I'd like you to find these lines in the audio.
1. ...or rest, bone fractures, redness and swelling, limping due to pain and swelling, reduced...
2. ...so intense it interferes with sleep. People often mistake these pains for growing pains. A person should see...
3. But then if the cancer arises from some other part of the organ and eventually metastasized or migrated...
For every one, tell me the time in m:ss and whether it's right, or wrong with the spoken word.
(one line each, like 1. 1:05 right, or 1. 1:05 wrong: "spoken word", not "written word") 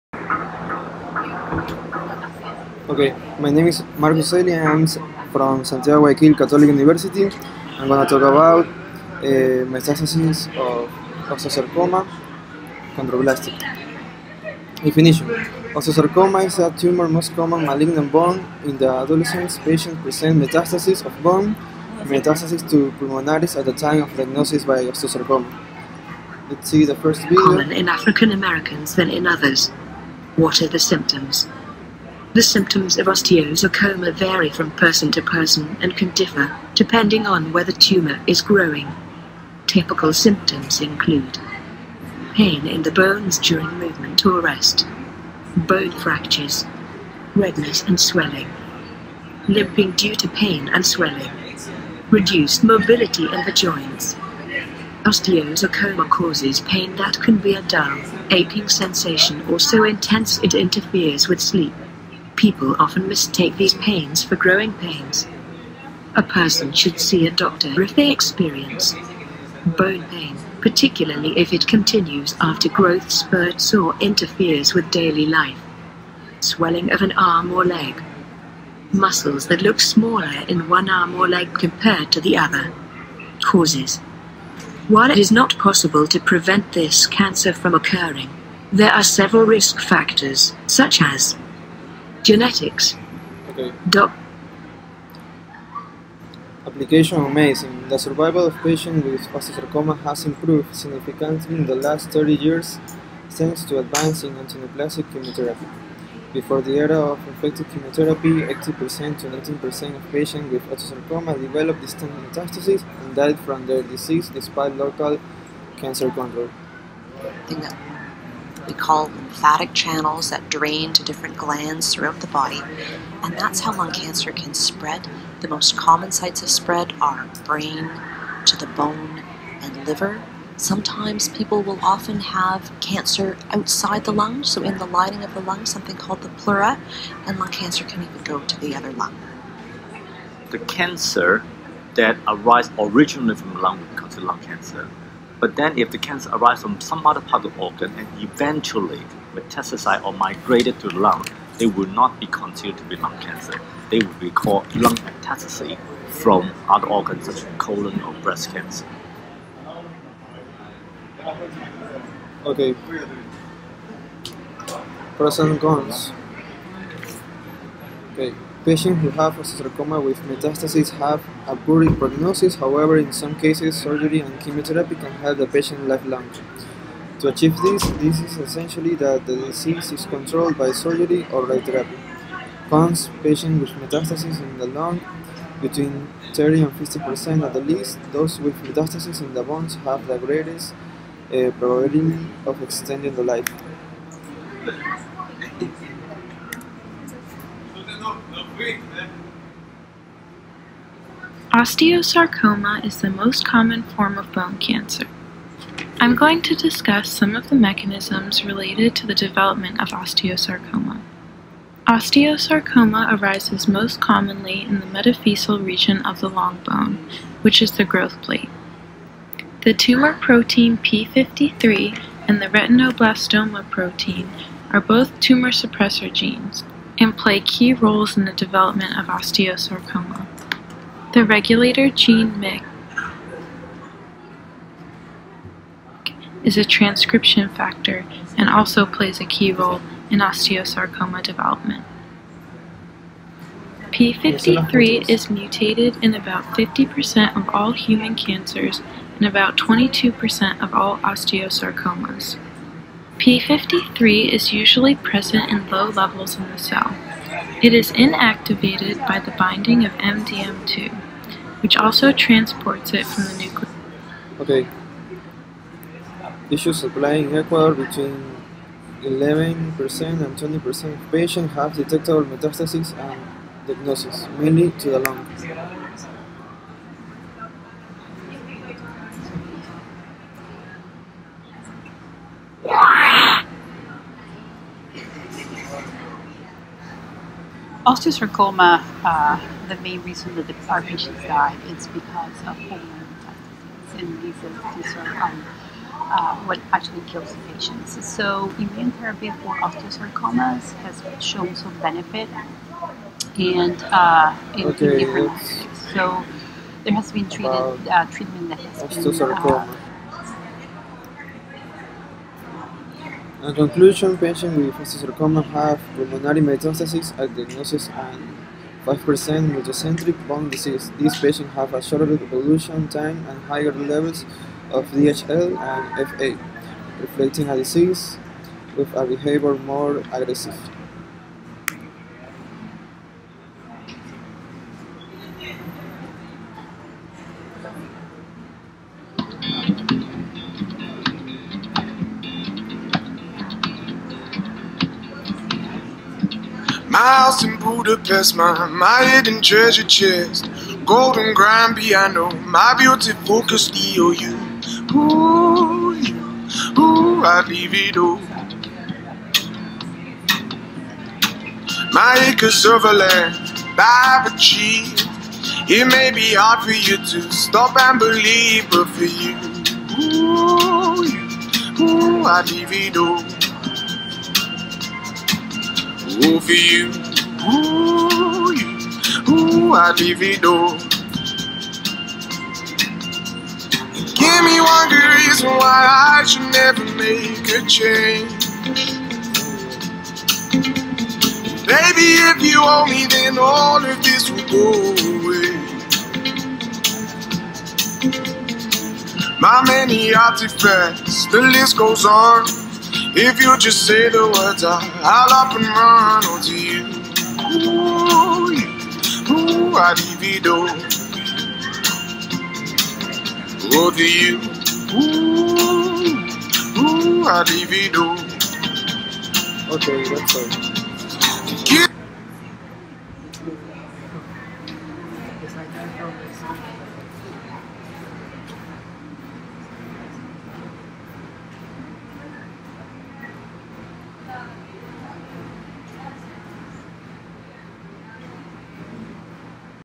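1. 0:44 right
2. 0:59 right
3. 2:25 right.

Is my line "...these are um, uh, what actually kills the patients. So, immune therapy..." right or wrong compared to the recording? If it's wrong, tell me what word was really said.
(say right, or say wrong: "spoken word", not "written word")
right.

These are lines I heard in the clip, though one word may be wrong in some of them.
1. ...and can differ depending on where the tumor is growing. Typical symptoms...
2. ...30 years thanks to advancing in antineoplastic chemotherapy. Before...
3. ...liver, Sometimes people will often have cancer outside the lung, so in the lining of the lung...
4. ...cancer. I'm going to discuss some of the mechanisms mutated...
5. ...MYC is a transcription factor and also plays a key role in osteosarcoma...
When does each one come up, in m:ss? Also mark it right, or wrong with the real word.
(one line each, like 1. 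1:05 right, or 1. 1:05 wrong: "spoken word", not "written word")
1. 0:35 right
2. 1:42 right
3. 2:09 right
4. 3:24 wrong: "related", not "mutated"
5. 3:52 right.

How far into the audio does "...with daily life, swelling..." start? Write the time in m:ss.
1:14.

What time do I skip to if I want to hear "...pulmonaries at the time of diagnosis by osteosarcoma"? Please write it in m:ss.
0:22.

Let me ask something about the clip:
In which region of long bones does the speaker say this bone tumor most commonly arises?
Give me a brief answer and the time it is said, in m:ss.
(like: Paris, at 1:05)
Metaphyseal region, at 3:34.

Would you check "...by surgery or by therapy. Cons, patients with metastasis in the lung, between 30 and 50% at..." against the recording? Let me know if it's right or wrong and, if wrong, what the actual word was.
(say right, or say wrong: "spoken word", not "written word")
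right.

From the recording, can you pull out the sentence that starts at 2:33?
They would be called lung metastasis from other organs such as colon or breast cancer.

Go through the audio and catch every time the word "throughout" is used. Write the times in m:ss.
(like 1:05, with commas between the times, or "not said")
2:01.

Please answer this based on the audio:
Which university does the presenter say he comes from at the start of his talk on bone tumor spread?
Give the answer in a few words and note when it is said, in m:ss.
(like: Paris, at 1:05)
Santiago Guayaquil Catholic University, at 0:05.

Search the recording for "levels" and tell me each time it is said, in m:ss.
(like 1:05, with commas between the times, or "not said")
4:15, 5:23.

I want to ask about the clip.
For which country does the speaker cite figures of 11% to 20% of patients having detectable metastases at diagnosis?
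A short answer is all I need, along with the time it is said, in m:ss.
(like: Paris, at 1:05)
Ecuador, at 4:27.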